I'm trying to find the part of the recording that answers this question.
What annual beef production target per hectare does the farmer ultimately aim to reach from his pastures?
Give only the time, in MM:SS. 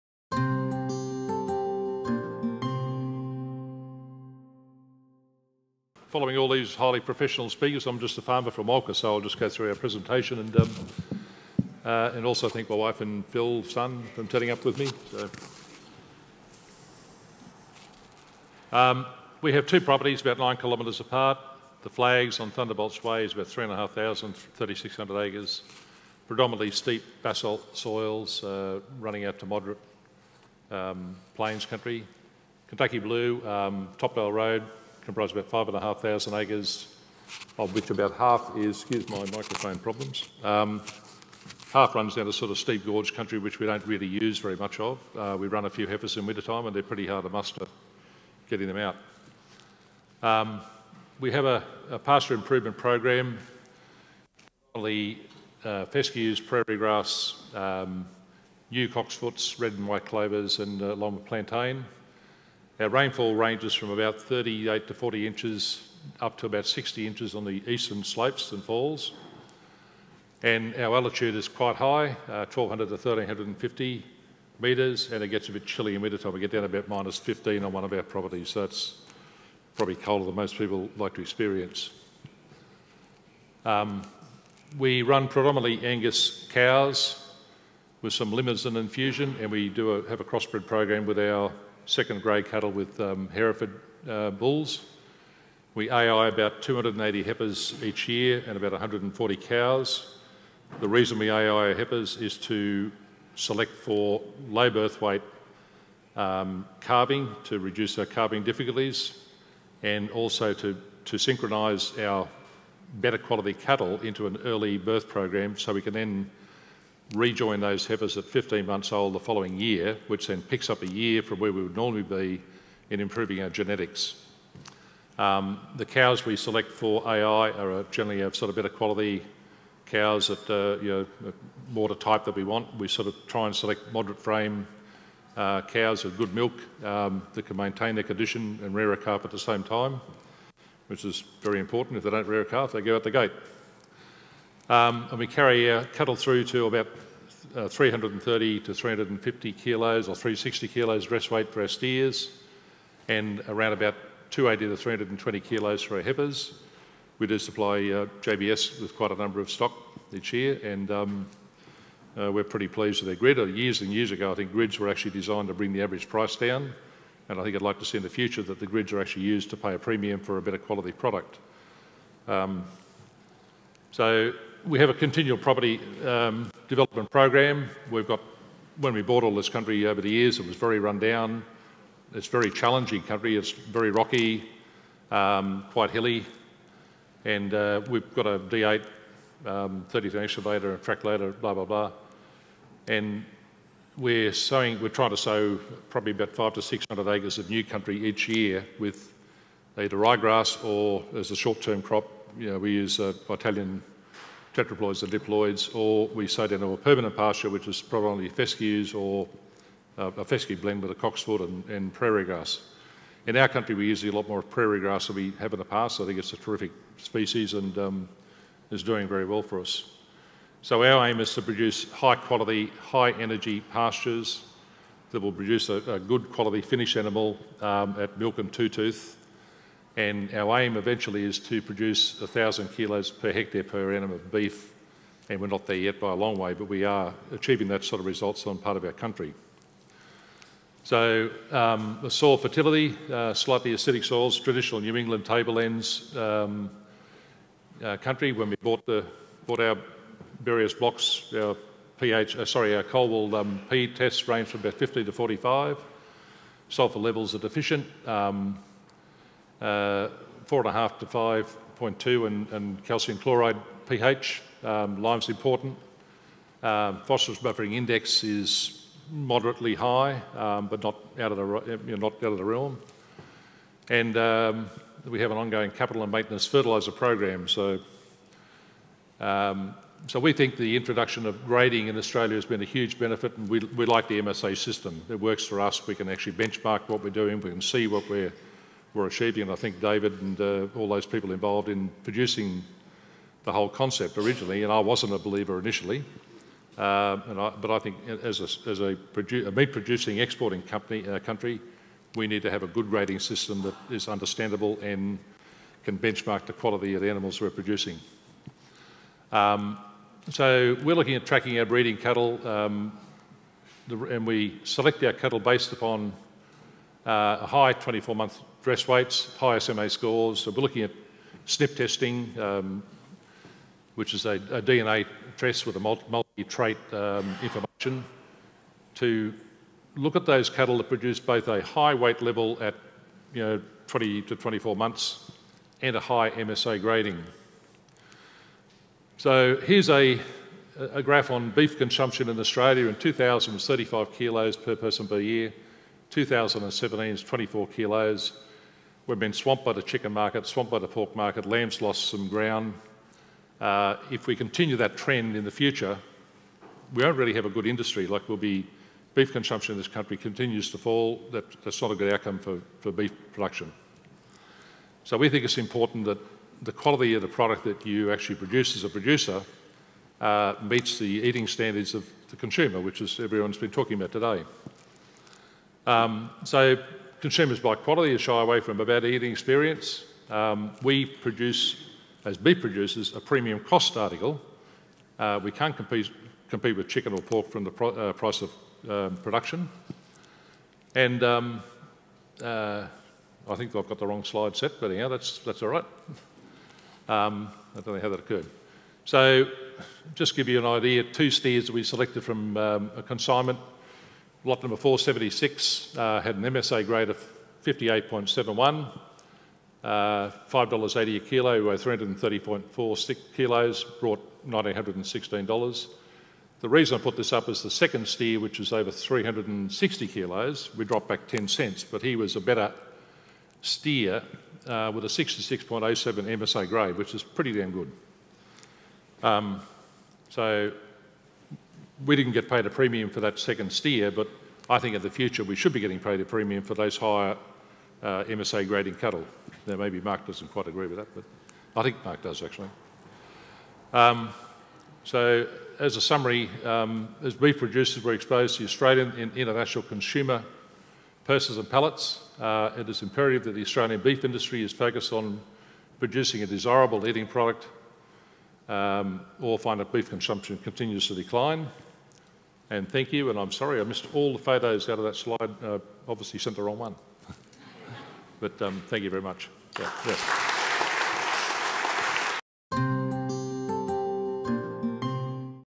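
03:52.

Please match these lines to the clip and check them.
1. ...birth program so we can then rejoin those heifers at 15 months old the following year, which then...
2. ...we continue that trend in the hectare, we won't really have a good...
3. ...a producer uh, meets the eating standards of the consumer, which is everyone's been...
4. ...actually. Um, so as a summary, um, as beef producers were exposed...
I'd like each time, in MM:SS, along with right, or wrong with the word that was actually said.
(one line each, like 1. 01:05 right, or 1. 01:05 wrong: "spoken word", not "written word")
1. 01:54 right
2. 05:54 wrong: "future", not "hectare"
3. 06:08 right
4. 07:22 right.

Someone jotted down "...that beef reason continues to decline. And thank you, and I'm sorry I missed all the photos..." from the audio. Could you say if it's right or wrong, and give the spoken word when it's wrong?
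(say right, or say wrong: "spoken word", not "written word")
wrong: "consumption", not "reason".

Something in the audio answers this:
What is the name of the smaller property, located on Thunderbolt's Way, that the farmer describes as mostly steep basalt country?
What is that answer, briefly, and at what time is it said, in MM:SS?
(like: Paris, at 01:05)
The Flags, at 00:21.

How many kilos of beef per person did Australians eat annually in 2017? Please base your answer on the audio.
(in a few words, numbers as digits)
24 kilos.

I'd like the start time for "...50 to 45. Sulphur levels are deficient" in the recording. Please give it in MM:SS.
04:14.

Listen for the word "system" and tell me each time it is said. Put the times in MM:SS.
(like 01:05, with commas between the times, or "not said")
04:44, 05:03.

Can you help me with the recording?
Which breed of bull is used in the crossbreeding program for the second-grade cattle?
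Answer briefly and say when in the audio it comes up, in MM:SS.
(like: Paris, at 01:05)
Hereford, at 01:33.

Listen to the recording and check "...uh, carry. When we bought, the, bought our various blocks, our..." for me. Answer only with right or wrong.
wrong.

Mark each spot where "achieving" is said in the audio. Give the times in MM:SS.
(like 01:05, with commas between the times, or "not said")
03:57, 04:49.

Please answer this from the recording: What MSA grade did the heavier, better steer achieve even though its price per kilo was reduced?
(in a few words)
66.07.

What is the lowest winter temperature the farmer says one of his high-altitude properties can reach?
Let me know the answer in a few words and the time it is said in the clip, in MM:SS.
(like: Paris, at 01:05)
minus 15, at 01:16.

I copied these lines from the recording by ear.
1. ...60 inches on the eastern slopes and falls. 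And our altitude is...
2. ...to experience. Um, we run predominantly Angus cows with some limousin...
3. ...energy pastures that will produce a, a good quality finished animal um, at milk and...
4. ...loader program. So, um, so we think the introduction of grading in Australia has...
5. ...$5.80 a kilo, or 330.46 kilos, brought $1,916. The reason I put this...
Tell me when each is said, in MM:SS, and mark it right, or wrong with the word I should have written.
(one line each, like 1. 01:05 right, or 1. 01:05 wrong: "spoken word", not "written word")
1. 01:06 right
2. 01:21 right
3. 03:43 right
4. 04:36 wrong: "fertiliser", not "loader"
5. 06:49 right.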